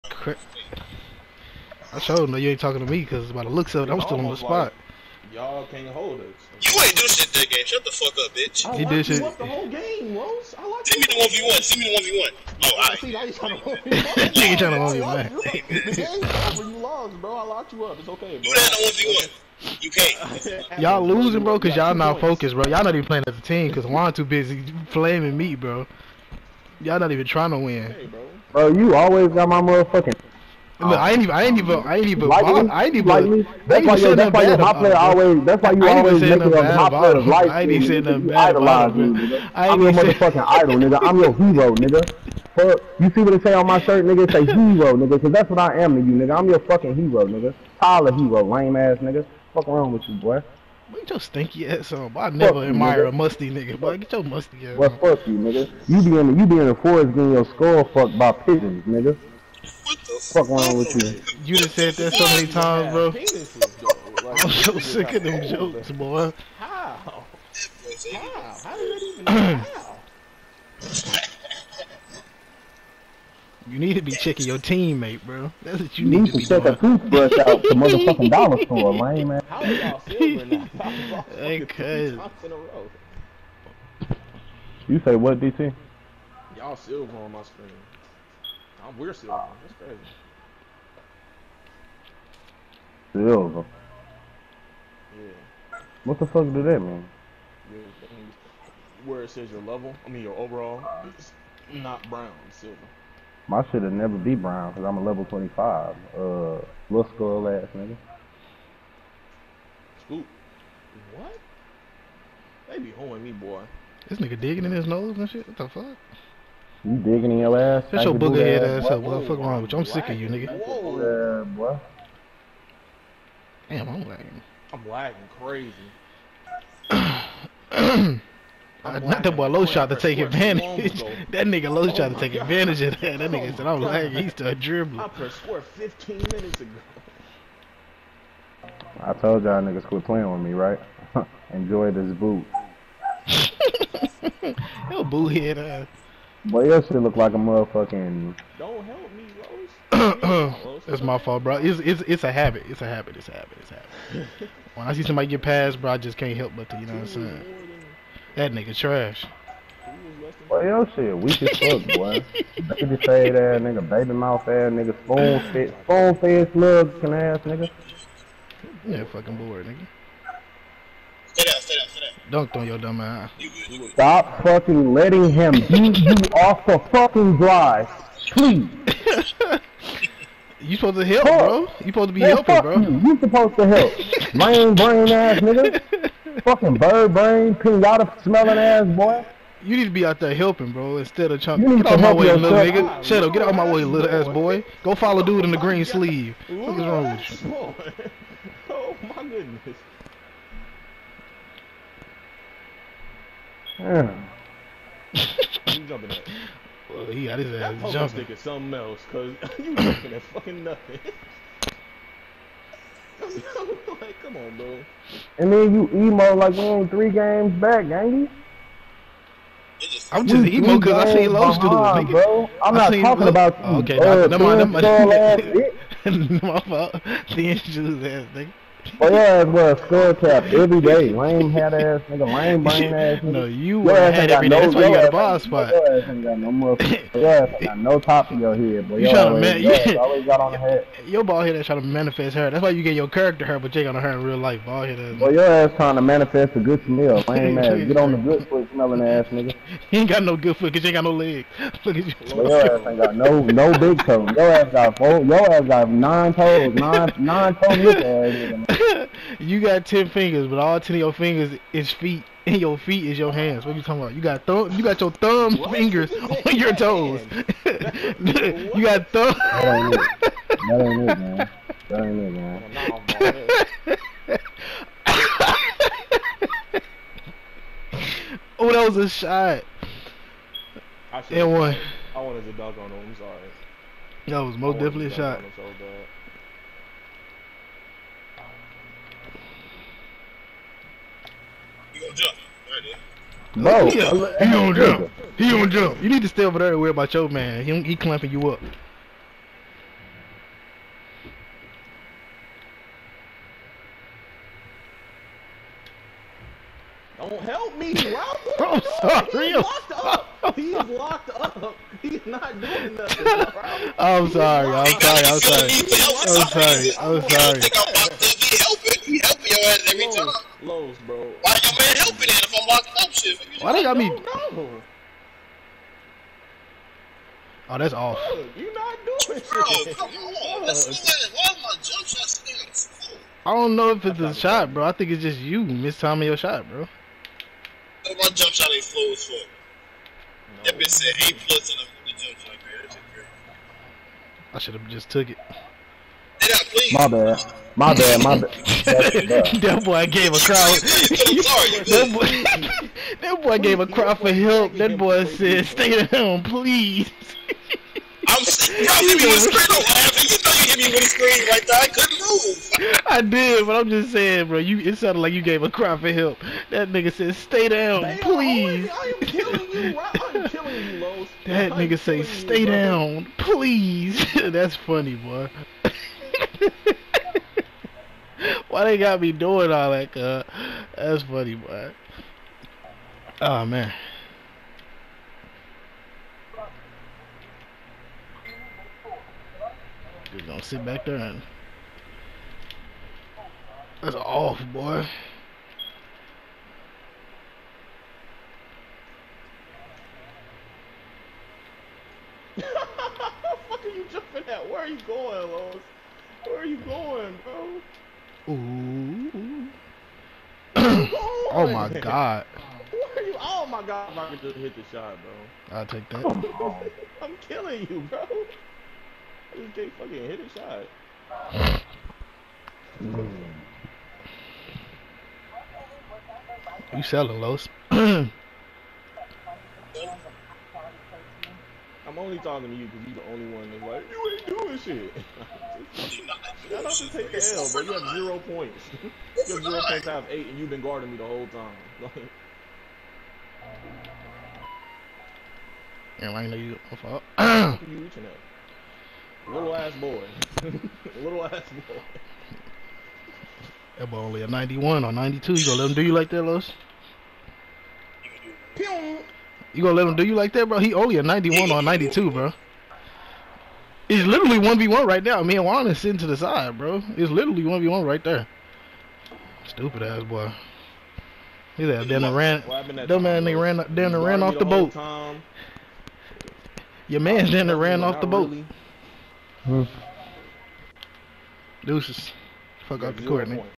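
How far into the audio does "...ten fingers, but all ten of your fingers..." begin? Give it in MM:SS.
04:19.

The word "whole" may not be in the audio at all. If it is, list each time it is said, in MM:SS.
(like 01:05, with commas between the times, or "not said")
00:09, 07:21.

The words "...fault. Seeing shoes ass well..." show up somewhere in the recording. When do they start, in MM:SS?
03:46.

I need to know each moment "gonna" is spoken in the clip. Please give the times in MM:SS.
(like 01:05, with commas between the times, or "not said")
06:30, 07:35, 07:39.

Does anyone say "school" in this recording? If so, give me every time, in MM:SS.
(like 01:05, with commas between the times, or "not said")
not said.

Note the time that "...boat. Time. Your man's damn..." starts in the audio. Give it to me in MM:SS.
07:54.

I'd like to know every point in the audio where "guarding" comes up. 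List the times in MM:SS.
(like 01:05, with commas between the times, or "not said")
07:20.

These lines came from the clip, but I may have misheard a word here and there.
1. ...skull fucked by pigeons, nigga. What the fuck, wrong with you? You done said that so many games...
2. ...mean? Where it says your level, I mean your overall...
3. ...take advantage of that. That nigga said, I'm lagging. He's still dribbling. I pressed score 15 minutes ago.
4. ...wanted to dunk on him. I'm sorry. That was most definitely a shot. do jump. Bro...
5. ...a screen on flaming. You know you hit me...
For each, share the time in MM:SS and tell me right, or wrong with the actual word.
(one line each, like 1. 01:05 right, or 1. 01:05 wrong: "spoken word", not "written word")
1. 00:57 wrong: "times", not "games"
2. 01:36 right
3. 02:12 right
4. 04:42 right
5. 05:59 wrong: "laughing", not "flaming".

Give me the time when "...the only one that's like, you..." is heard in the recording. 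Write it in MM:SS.
07:13.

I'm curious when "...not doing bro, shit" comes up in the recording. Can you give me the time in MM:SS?
05:28.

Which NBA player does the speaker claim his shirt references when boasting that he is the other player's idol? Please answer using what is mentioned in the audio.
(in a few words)
Tyler Herro.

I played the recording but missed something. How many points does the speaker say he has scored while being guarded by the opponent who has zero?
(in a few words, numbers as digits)
8.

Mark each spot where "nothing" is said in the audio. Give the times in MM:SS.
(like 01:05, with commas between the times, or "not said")
00:38, 03:30, 05:12.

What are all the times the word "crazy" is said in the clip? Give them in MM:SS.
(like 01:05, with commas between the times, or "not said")
01:29, 02:05.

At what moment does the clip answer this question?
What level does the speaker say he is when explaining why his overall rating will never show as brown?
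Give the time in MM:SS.
01:45.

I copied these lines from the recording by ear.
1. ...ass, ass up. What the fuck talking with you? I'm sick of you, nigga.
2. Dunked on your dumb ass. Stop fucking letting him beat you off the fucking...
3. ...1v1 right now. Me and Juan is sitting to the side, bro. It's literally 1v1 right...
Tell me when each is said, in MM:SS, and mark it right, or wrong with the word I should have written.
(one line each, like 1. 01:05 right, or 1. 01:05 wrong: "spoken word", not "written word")
1. 01:58 wrong: "wrong", not "talking"
2. 02:52 right
3. 07:44 right.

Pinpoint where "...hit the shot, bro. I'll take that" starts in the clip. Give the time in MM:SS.
06:54.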